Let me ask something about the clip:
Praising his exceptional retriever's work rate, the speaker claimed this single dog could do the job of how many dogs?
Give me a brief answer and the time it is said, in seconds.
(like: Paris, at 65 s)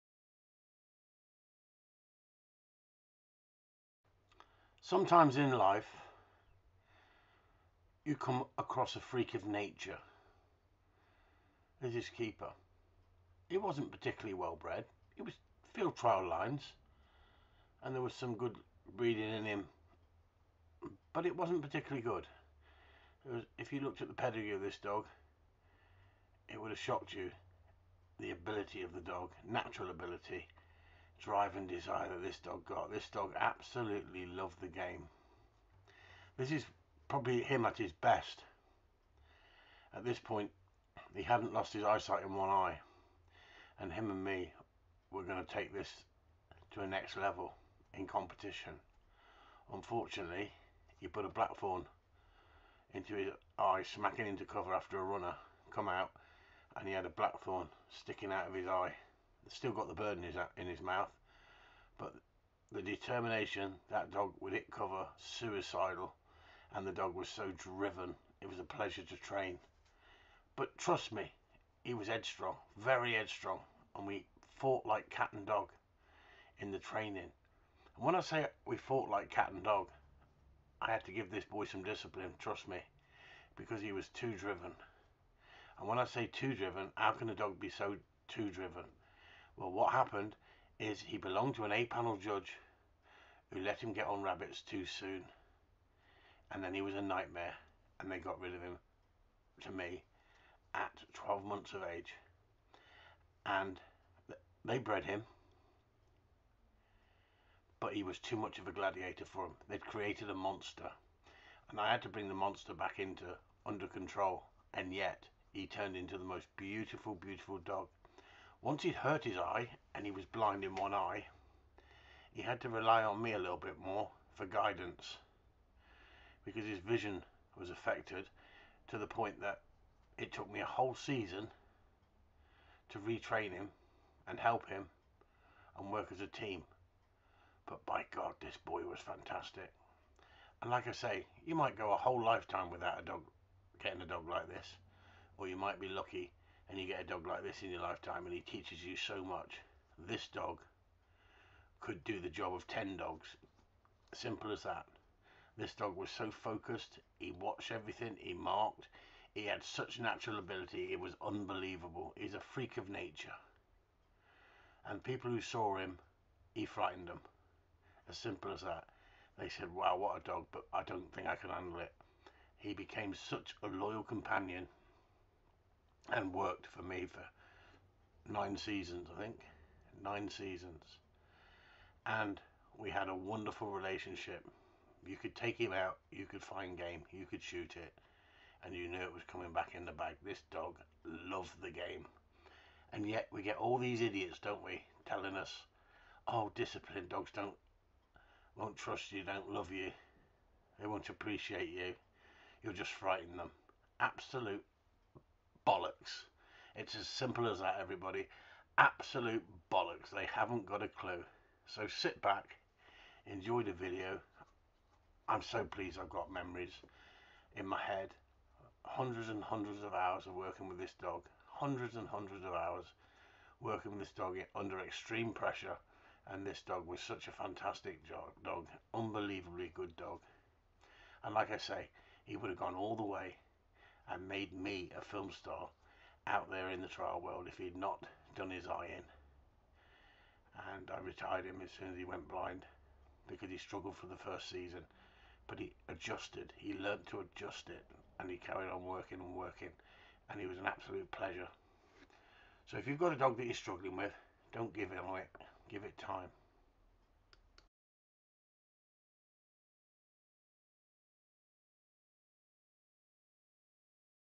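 10, at 152 s.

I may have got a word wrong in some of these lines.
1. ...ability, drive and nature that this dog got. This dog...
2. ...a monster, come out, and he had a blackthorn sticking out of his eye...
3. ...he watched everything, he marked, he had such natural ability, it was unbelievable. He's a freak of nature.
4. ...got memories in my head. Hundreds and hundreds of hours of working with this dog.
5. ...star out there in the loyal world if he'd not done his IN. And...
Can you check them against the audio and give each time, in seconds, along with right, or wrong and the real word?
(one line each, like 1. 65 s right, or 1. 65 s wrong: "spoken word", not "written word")
1. 29 s wrong: "desire", not "nature"
2. 54 s wrong: "runner", not "monster"
3. 157 s right
4. 216 s right
5. 235 s wrong: "trial", not "loyal".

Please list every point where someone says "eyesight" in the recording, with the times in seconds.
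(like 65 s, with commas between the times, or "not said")
41 s.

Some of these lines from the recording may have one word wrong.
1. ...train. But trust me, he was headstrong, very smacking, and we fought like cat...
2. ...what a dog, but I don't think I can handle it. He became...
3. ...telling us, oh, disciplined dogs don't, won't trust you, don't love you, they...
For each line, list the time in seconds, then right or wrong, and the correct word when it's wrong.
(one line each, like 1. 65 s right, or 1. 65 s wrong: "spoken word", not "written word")
1. 69 s wrong: "headstrong", not "smacking"
2. 169 s right
3. 195 s right.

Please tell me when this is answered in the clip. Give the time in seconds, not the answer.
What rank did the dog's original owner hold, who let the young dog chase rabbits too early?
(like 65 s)
91 s.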